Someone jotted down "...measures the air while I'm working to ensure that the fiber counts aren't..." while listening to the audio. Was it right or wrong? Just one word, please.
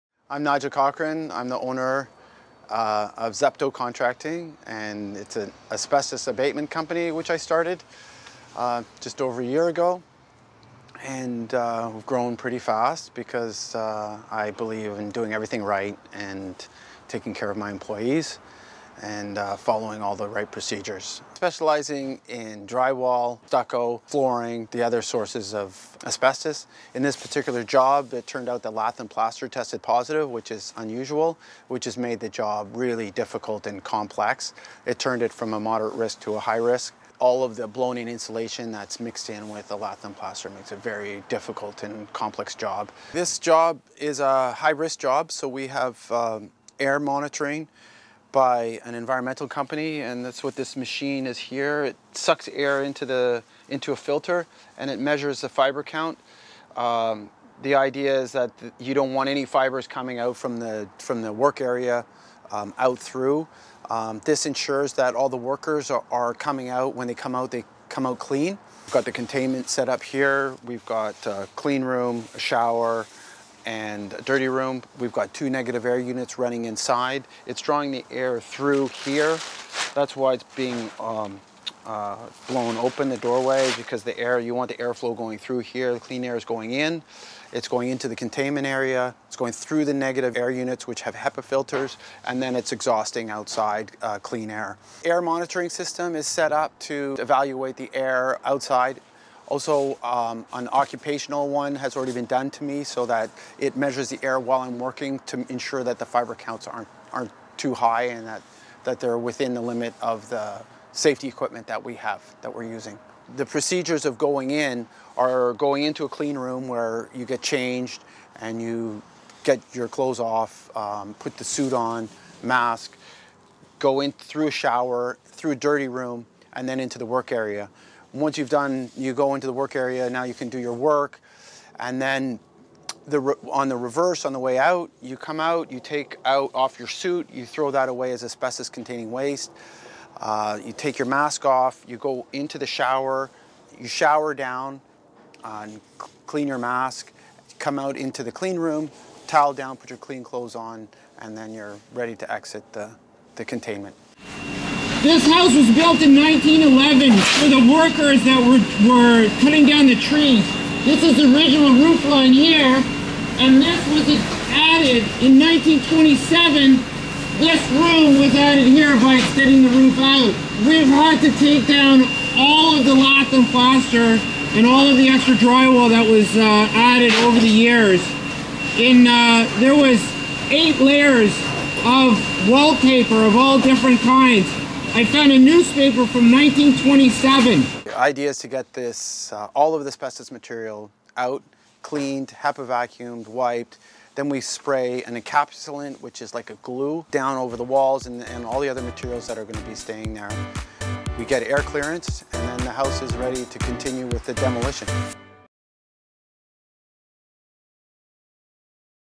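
right.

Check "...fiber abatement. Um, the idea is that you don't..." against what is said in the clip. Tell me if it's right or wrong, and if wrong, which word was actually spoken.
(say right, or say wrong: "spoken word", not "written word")
wrong: "count", not "abatement".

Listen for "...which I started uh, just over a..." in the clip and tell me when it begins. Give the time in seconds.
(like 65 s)
7 s.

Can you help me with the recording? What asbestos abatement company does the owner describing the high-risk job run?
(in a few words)
Zepto Contracting.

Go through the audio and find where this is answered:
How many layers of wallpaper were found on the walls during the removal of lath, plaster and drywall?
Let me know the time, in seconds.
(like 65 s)
180 s.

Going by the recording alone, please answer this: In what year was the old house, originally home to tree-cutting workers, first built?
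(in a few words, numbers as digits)
1911.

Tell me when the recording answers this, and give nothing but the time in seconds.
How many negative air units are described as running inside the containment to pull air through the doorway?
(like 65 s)
75 s.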